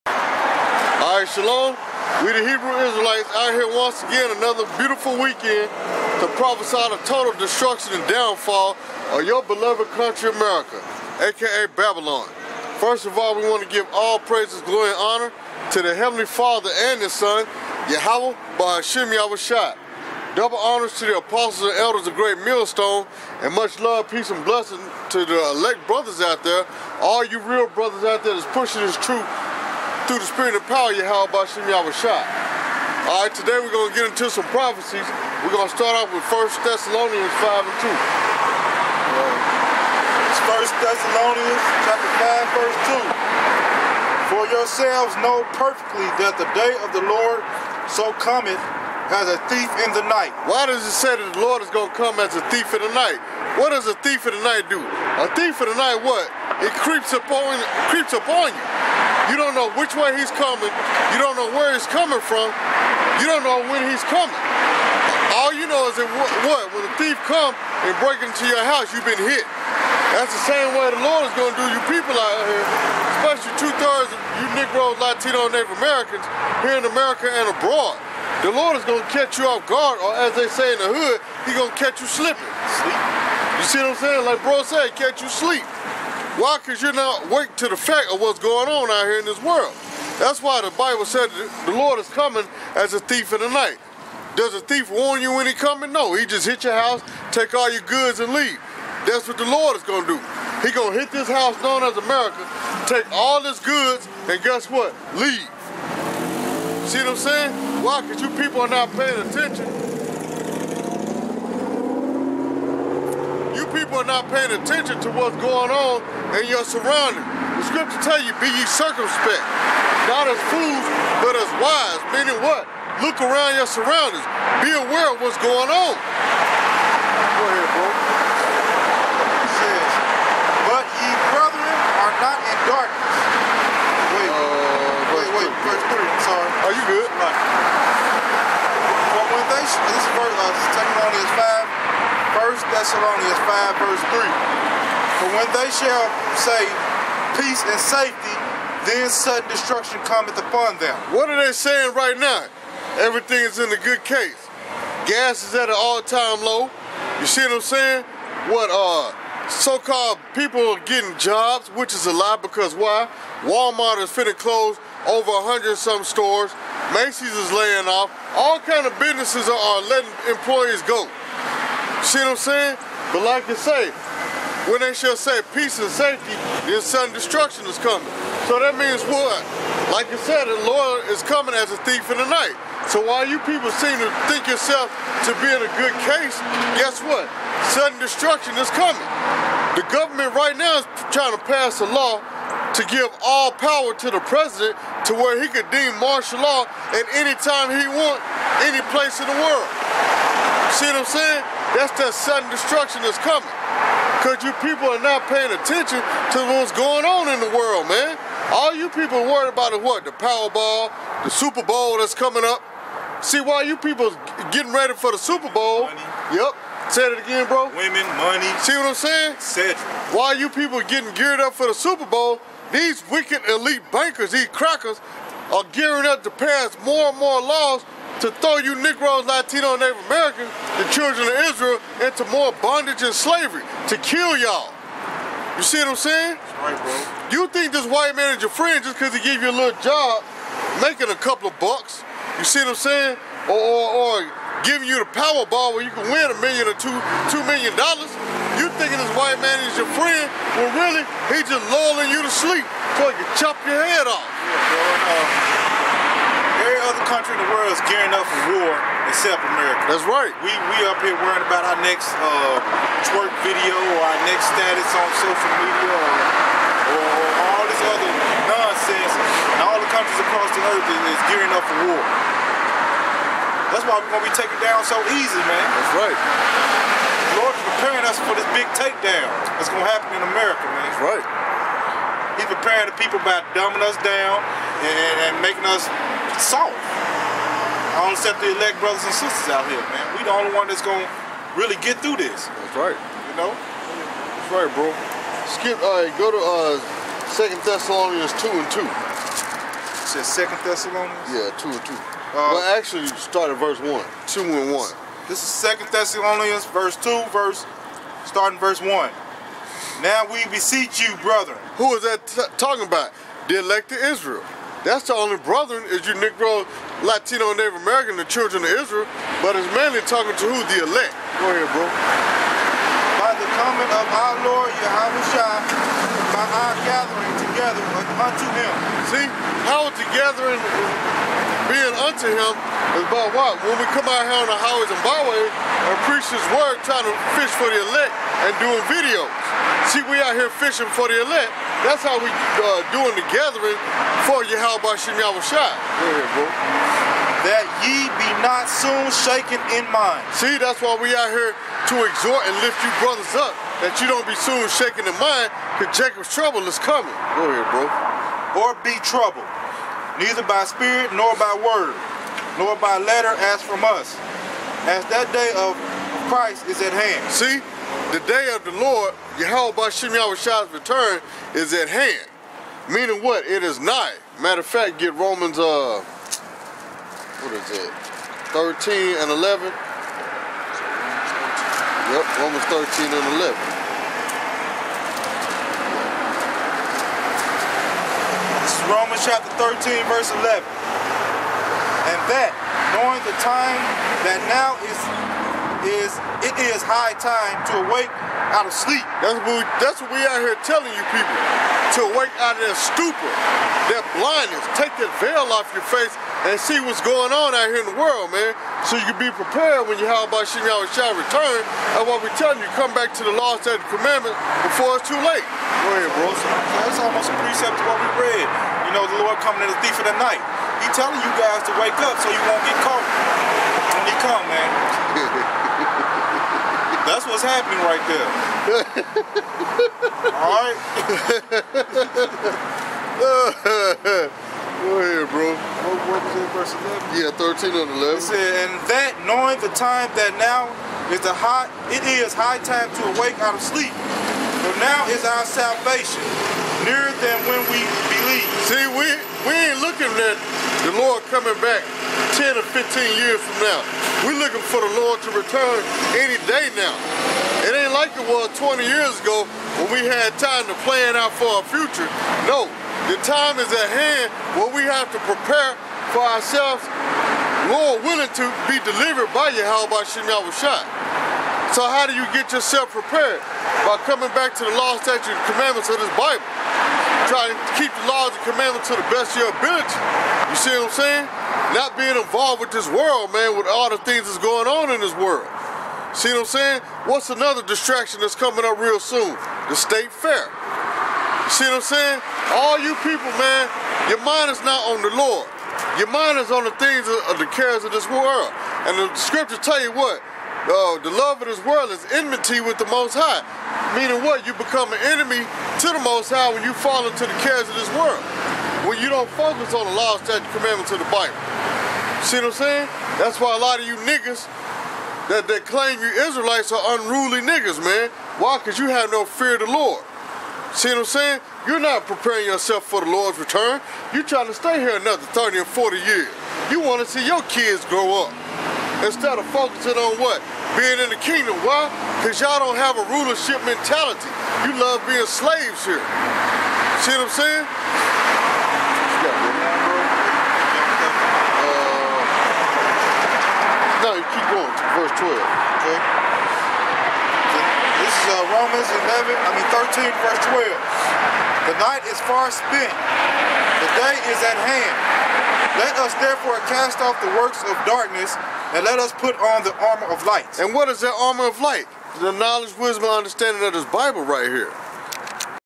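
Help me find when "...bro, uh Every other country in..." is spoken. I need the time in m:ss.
4:15.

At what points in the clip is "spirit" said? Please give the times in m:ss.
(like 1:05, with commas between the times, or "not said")
0:30, 6:00.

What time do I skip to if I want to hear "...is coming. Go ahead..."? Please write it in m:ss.
5:56.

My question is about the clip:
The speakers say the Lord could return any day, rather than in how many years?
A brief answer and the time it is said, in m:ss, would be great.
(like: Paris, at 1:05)
10 or 15, at 7:32.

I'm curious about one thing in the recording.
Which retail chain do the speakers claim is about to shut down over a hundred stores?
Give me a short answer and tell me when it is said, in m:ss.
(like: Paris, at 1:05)
Walmart, at 2:43.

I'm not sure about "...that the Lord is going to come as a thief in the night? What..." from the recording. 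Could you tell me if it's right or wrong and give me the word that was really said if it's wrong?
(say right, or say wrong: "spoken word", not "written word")
right.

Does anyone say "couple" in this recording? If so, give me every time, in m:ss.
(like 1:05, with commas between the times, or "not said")
4:01.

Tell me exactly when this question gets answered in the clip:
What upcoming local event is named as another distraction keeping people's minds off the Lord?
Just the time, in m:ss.
8:09.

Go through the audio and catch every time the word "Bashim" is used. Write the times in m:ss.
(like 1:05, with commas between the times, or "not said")
0:31, 6:09.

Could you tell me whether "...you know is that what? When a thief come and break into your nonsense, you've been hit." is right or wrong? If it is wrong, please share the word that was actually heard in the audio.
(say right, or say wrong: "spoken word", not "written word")
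wrong: "house", not "nonsense".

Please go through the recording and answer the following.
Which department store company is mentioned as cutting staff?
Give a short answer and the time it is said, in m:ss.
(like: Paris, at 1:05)
Macy's, at 2:46.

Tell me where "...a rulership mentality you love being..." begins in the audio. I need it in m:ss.
8:53.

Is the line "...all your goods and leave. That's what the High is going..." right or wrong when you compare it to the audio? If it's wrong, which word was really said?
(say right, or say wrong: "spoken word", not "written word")
wrong: "Lord", not "High".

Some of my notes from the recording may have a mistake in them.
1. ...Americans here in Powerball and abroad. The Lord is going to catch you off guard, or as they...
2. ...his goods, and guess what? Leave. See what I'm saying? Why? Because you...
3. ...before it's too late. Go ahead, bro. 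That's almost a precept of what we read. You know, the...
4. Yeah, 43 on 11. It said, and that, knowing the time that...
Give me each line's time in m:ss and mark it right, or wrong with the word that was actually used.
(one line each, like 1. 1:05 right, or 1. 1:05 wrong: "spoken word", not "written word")
1. 1:15 wrong: "America", not "Powerball"
2. 1:43 right
3. 6:54 right
4. 7:17 wrong: "13", not "43".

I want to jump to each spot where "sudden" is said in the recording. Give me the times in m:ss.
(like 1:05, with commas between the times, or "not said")
2:29, 2:56, 3:07, 3:22.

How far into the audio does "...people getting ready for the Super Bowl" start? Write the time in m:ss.
3:33.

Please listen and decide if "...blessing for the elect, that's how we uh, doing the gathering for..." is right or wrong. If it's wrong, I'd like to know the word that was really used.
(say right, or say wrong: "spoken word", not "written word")
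wrong: "fishing", not "blessing".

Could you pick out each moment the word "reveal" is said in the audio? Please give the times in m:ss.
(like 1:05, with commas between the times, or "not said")
not said.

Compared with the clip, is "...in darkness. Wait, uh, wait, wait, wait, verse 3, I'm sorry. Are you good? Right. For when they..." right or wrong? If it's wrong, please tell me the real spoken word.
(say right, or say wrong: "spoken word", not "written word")
right.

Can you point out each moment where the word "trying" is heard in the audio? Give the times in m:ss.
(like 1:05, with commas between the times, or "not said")
3:11, 5:36, 8:44.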